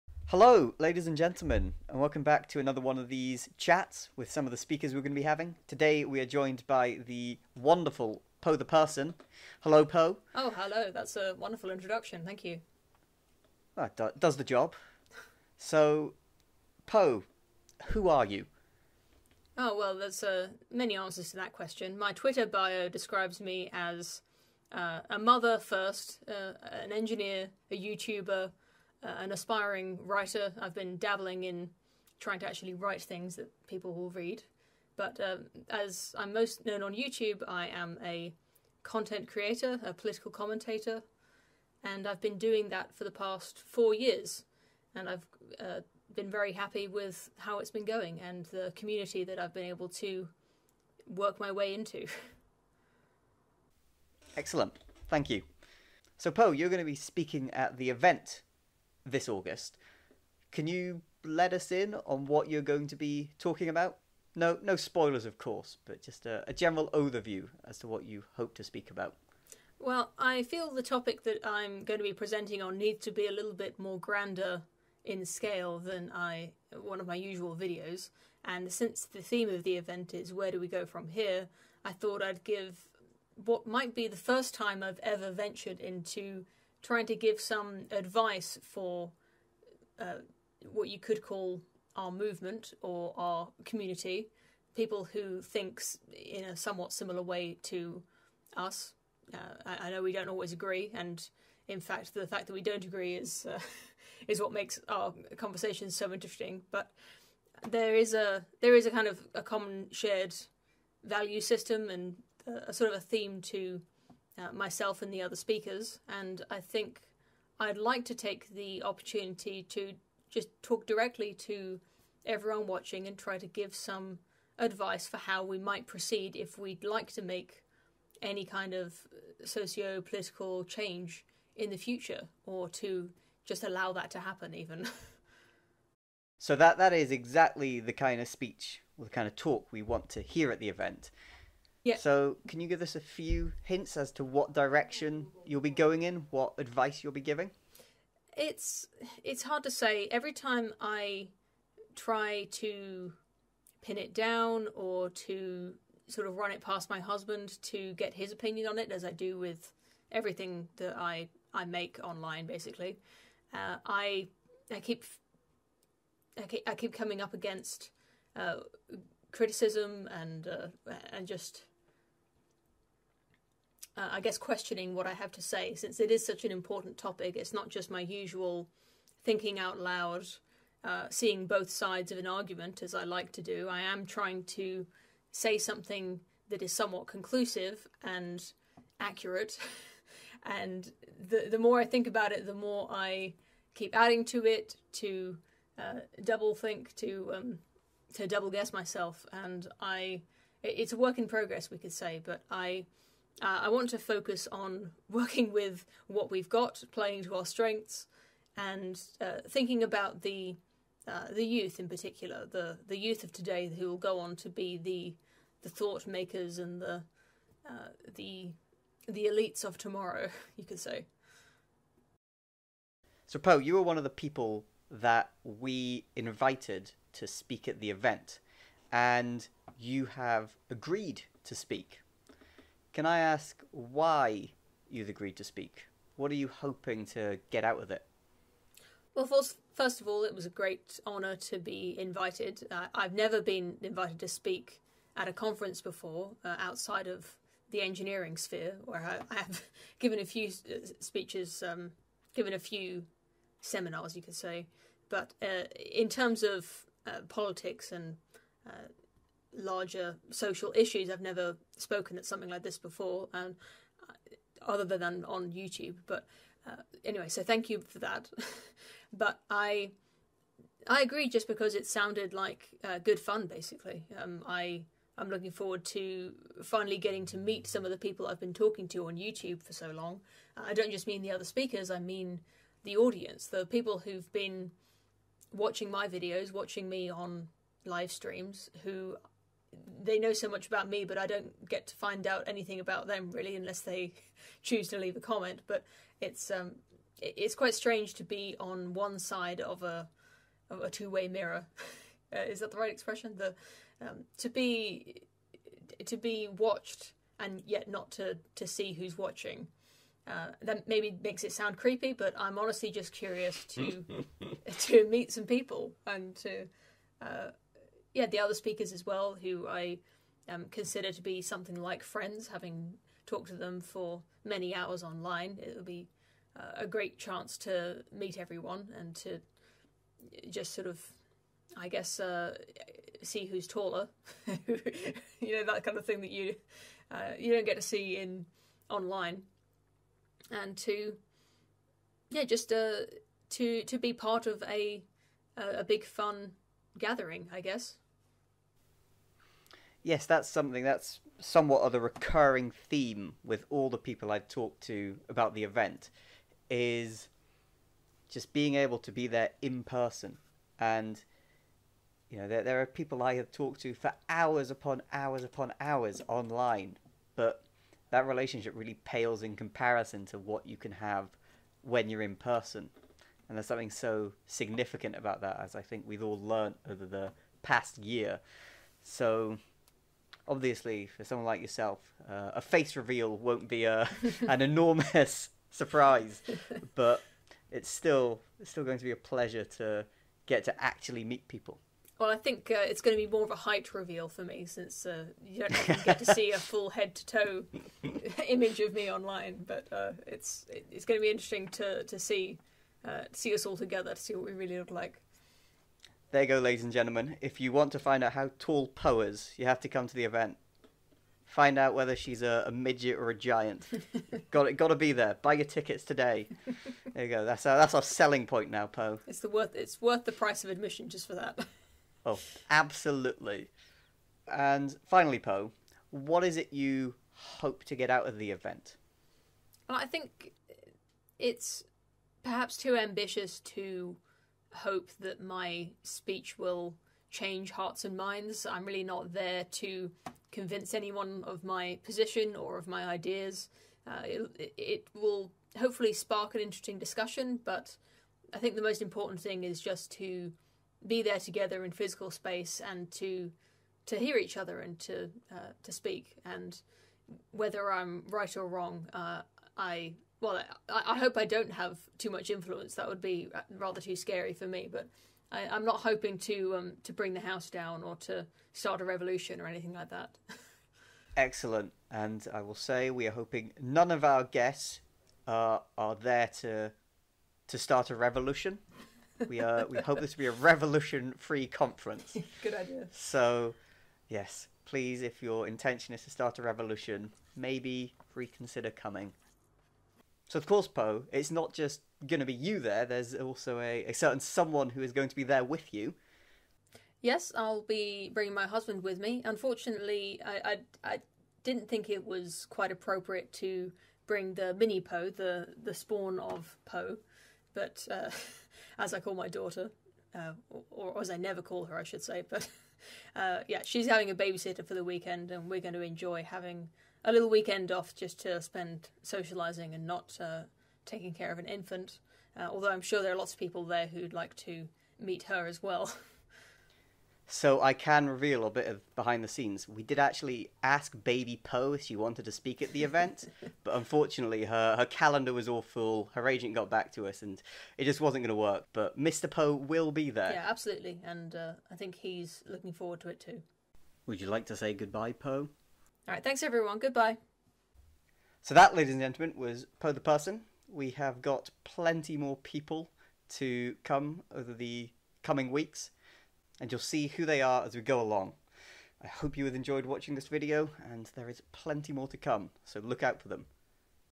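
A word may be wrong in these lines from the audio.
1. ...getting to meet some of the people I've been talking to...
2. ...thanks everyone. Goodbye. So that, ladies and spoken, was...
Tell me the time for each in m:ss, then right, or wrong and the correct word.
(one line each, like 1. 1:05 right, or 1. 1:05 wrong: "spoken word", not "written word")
1. 4:36 right
2. 9:06 wrong: "gentlemen", not "spoken".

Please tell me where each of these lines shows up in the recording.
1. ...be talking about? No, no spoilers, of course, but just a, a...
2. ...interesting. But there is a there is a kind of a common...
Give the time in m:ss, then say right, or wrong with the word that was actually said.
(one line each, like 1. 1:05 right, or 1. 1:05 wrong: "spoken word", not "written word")
1. 1:02 right
2. 1:46 right.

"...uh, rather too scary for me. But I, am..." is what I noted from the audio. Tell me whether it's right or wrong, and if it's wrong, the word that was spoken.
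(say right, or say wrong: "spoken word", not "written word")
right.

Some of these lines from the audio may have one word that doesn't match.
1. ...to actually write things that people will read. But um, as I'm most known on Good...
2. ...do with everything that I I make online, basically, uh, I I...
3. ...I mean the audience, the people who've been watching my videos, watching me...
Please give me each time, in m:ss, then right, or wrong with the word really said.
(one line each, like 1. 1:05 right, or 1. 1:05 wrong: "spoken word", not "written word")
1. 0:32 wrong: "YouTube", not "Good"
2. 2:39 right
3. 4:41 right.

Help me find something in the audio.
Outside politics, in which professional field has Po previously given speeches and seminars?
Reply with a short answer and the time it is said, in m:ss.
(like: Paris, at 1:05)
Engineering, at 4:07.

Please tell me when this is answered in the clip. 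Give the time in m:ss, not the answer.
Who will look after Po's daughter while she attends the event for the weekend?
8:34.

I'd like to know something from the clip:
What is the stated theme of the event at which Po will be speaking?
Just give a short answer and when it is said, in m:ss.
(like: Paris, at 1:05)
Where do we go from here, at 1:20.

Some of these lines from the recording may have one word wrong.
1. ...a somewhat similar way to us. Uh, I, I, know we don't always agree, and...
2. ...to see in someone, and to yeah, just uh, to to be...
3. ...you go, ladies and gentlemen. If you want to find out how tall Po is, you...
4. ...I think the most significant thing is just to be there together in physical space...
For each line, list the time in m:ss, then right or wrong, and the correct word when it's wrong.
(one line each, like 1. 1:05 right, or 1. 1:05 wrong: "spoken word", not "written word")
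1. 1:36 right
2. 5:37 wrong: "online", not "someone"
3. 6:46 right
4. 7:28 wrong: "important", not "significant".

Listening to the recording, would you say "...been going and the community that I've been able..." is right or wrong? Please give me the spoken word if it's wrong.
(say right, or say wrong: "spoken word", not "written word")
right.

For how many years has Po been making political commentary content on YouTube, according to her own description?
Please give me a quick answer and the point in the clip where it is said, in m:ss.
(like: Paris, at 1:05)
4 years, at 0:43.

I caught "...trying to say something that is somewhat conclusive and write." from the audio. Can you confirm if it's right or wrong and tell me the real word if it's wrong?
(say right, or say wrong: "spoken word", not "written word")
wrong: "accurate", not "write".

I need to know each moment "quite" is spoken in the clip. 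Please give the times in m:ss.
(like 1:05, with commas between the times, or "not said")
4:57, 8:22.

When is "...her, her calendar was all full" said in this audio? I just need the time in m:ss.
8:54.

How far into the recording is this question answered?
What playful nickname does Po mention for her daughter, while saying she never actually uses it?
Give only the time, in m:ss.
8:25.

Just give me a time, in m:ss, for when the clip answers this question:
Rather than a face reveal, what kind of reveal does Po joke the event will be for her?
6:33.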